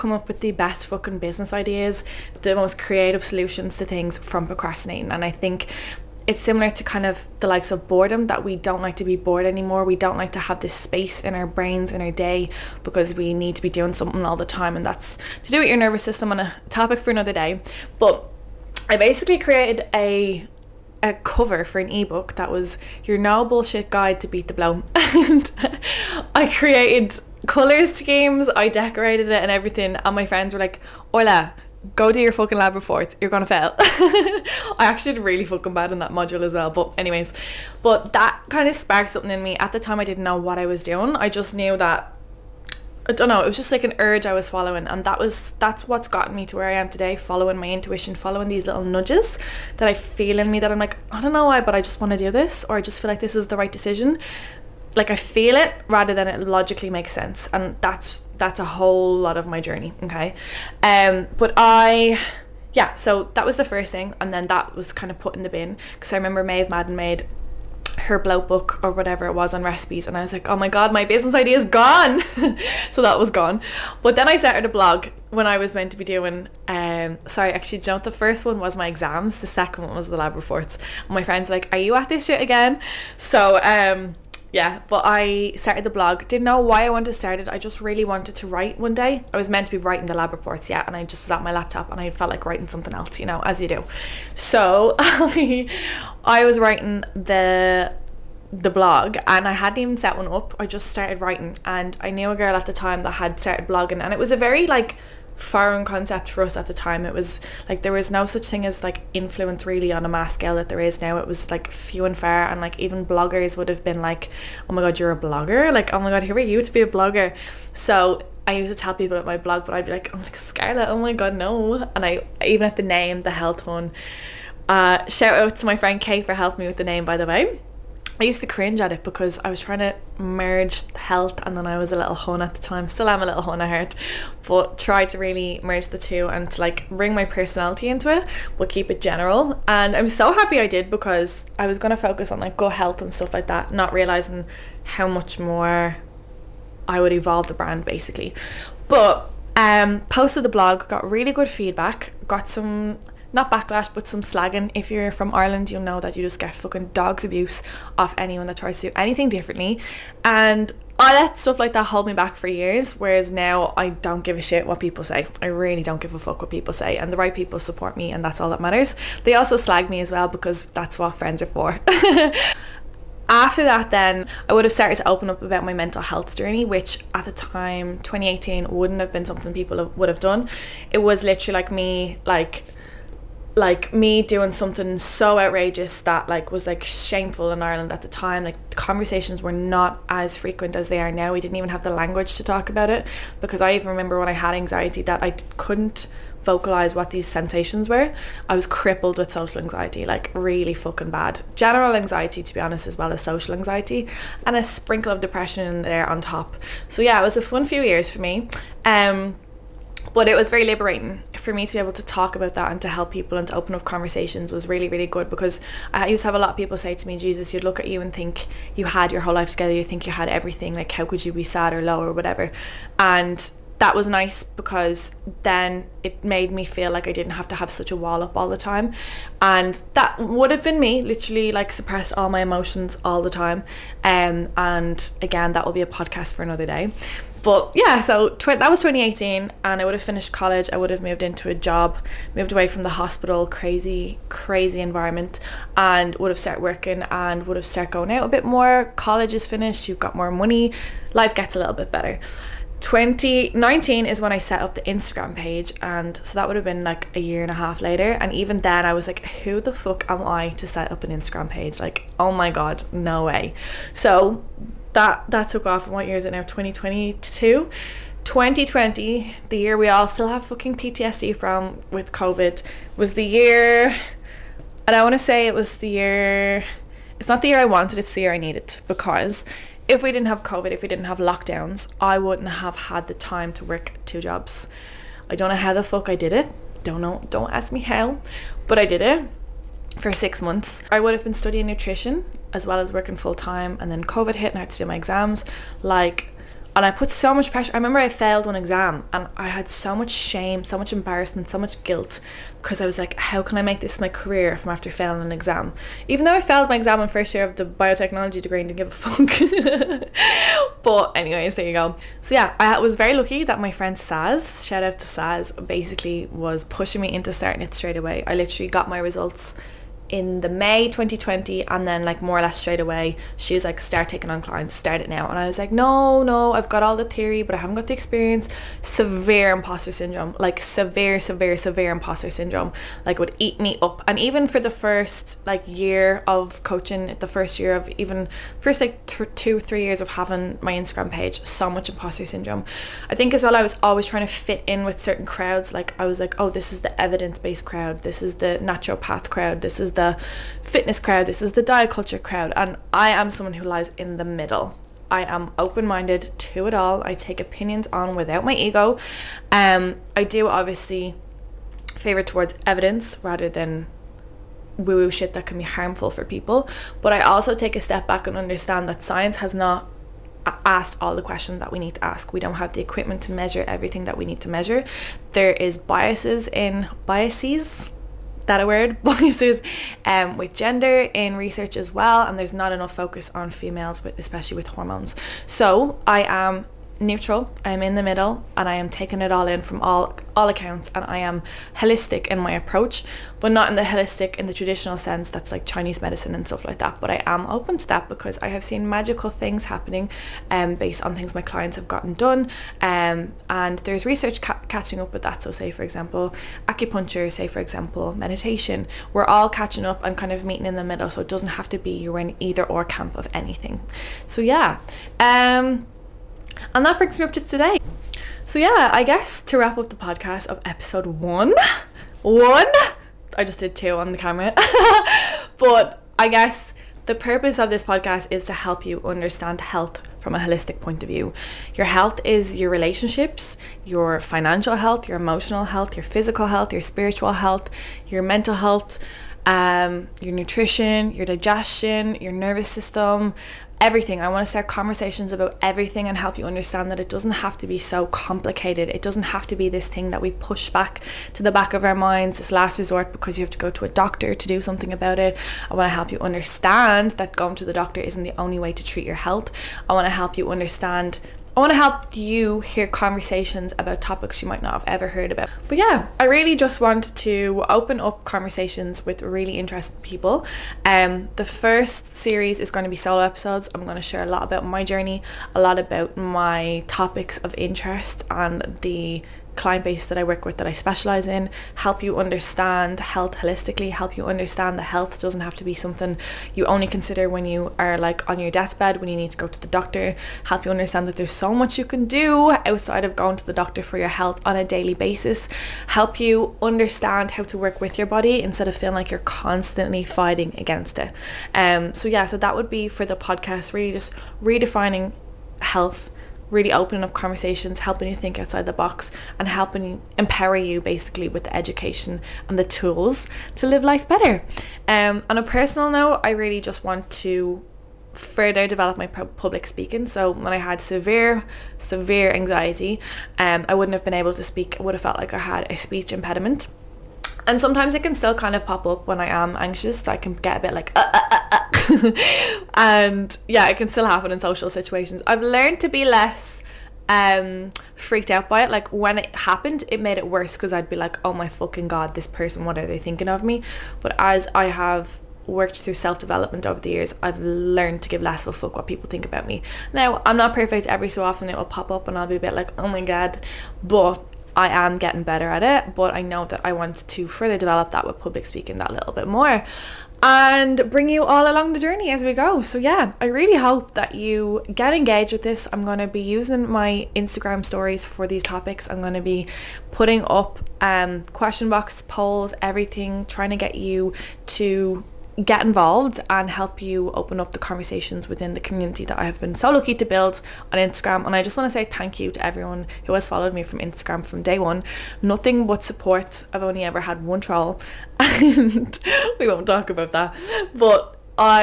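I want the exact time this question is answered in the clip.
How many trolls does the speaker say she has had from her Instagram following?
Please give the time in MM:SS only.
09:47.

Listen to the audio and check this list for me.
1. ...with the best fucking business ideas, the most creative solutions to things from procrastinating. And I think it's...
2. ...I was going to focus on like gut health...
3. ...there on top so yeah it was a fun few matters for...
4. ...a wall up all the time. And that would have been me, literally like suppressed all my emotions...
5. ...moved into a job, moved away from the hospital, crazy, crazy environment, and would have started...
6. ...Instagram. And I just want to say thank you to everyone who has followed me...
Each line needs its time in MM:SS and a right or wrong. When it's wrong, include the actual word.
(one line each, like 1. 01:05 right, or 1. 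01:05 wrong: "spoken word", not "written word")
1. 00:00 right
2. 02:21 right
3. 03:25 wrong: "years", not "matters"
4. 03:47 right
5. 04:01 right
6. 09:40 right.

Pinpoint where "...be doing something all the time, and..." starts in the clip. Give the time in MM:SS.
00:13.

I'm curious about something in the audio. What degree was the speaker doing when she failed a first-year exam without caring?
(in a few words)
Biotechnology.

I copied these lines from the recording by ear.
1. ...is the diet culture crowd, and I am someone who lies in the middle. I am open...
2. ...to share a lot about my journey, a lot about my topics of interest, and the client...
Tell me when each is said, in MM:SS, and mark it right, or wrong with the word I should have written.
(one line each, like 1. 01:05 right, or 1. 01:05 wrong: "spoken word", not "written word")
1. 05:51 right
2. 07:53 right.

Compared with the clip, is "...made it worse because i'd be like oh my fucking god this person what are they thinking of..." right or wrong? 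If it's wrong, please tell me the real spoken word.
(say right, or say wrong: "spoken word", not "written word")
right.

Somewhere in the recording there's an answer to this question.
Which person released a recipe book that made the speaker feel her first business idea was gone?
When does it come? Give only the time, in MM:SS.
01:06.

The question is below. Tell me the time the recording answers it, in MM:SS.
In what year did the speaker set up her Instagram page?
04:12.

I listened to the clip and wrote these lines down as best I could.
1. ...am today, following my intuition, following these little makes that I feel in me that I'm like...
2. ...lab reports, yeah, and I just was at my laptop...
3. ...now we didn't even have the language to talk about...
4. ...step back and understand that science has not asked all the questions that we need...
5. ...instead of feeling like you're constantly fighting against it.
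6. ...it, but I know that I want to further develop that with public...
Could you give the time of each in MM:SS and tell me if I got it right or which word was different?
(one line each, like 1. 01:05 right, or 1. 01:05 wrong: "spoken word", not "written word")
1. 00:46 wrong: "nudges", not "makes"
2. 01:30 right
3. 03:11 right
4. 06:07 right
5. 08:18 right
6. 09:15 right.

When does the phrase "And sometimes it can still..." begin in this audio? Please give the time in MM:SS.
08:47.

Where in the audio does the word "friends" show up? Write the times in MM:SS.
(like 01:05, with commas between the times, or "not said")
00:30, 01:21, 02:05, 02:51, 05:13.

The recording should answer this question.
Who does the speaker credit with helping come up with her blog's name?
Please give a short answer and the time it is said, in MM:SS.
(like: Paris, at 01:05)
Kay, at 02:05.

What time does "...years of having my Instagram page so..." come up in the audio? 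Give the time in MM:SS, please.
05:39.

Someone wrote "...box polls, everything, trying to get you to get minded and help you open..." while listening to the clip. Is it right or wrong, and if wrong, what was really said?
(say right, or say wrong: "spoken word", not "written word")
wrong: "involved", not "minded".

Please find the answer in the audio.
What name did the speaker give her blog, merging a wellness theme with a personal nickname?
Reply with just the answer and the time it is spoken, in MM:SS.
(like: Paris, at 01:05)
The Health Hun, at 02:03.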